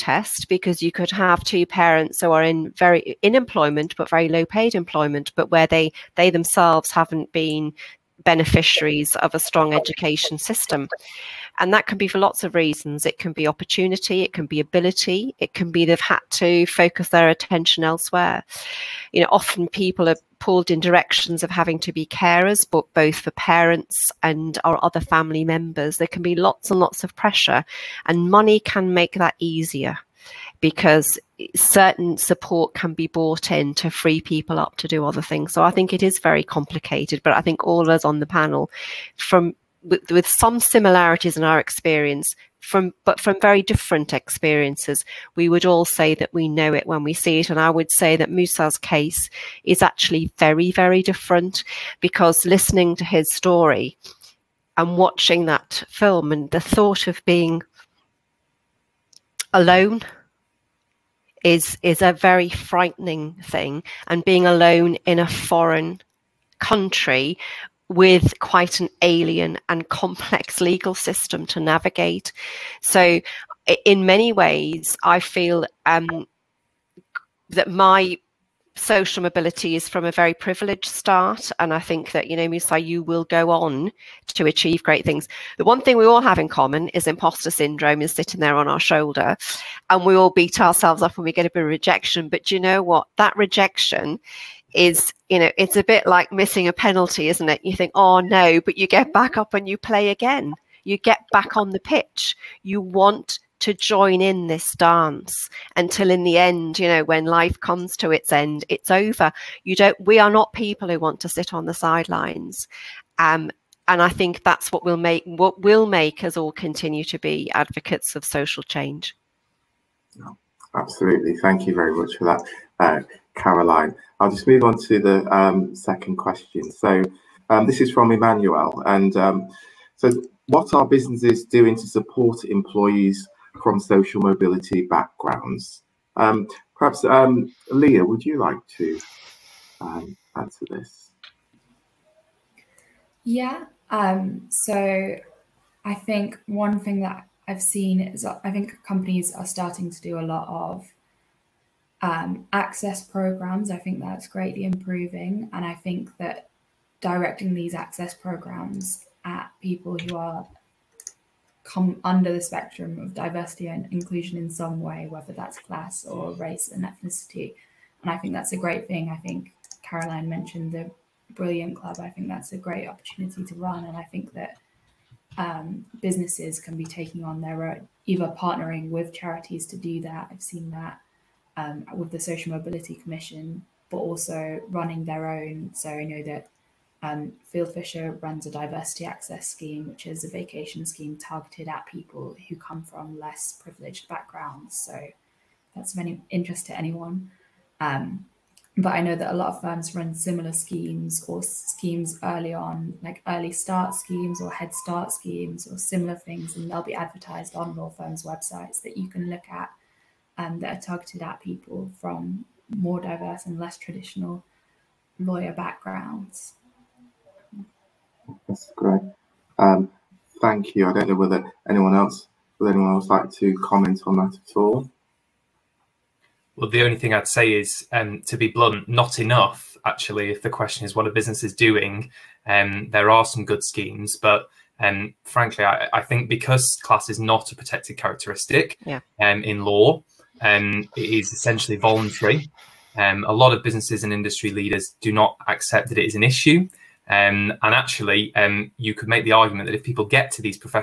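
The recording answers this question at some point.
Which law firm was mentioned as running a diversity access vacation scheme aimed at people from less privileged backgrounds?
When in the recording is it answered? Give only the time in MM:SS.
03:07.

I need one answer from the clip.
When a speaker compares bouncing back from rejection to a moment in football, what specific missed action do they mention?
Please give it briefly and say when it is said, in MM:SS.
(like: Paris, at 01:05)
Missing a penalty, at 01:36.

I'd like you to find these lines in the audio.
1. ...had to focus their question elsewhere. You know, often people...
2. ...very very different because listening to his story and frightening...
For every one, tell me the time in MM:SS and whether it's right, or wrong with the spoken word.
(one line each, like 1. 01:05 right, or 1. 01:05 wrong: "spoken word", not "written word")
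1. 00:15 wrong: "attention", not "question"
2. 00:50 wrong: "watching", not "frightening".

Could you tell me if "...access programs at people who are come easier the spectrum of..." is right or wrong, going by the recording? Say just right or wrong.
wrong.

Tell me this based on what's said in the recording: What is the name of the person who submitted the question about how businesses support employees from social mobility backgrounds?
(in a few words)
Emmanuel.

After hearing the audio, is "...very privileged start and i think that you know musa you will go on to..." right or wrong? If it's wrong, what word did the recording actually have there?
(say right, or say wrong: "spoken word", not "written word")
right.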